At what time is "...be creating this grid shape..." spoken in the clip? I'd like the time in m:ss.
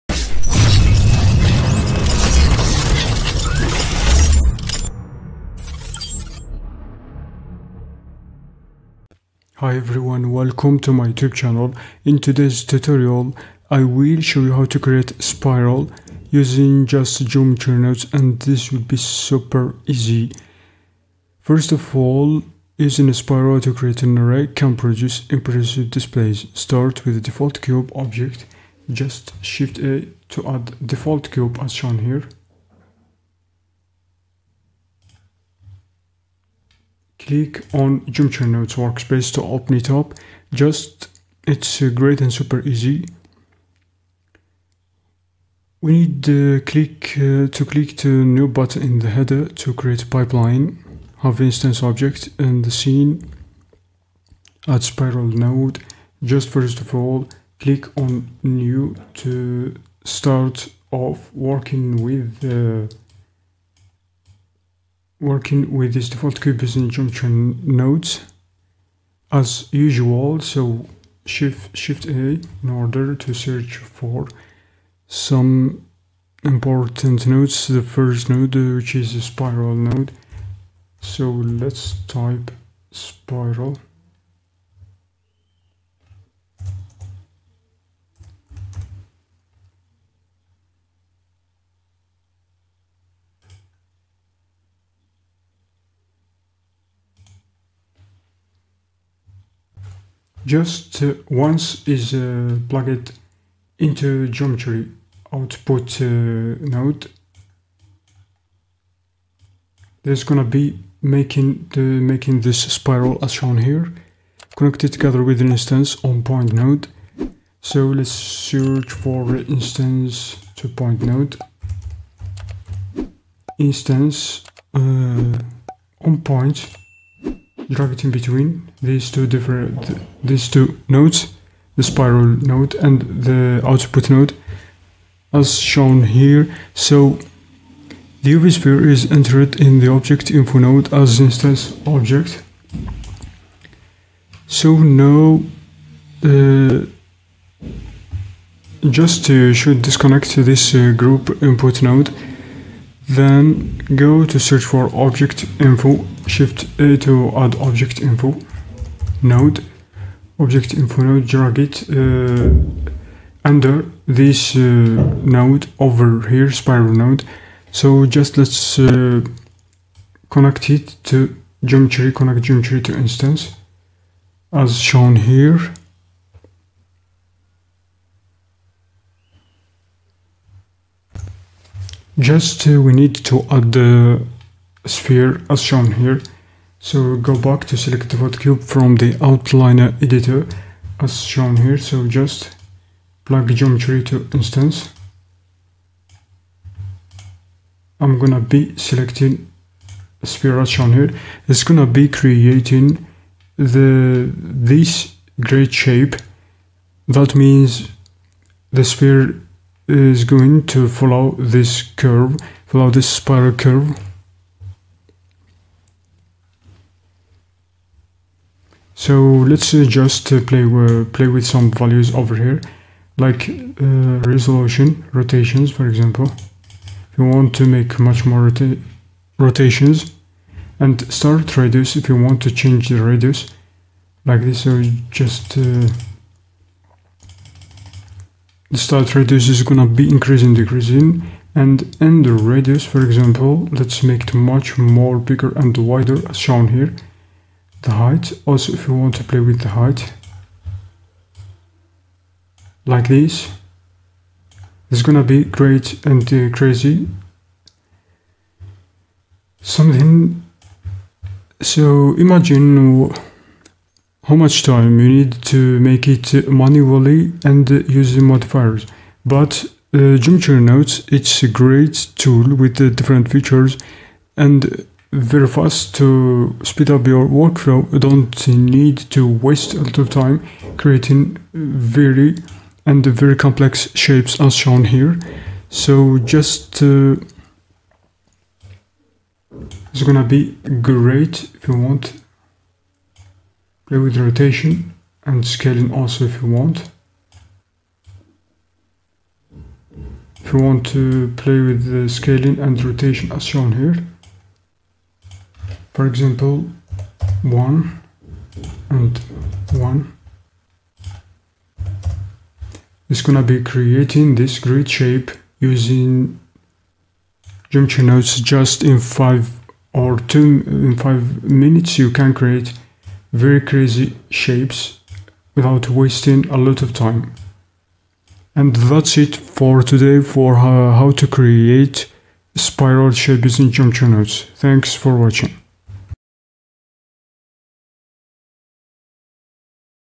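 5:13.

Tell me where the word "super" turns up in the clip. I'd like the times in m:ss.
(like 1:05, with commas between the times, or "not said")
0:18, 0:42.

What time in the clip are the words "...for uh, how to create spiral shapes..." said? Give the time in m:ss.
5:30.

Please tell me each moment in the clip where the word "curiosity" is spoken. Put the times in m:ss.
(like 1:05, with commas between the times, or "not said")
not said.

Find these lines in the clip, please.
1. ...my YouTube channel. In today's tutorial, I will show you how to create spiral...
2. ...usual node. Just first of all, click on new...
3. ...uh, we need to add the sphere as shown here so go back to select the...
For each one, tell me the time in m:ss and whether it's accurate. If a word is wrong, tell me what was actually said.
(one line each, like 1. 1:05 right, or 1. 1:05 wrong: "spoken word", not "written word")
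1. 0:10 right
2. 0:54 wrong: "spiral", not "usual"
3. 3:02 right.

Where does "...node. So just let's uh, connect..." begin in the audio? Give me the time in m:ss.
2:46.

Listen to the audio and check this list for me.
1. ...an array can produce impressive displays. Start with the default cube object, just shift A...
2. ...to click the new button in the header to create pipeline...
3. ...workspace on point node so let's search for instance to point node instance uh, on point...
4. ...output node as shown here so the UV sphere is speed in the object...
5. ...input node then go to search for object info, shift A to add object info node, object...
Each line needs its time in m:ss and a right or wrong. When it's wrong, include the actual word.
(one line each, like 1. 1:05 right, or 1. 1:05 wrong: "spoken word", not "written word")
1. 0:24 right
2. 0:47 right
3. 1:55 wrong: "instance", not "workspace"
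4. 2:13 wrong: "entered", not "speed"
5. 2:31 right.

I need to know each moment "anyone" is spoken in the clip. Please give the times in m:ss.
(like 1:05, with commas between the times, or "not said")
not said.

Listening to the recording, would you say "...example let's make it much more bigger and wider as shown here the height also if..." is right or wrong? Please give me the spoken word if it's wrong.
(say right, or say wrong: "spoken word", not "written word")
right.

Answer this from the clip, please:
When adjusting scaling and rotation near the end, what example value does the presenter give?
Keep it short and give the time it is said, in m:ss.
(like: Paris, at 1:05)
1 and 1, at 5:07.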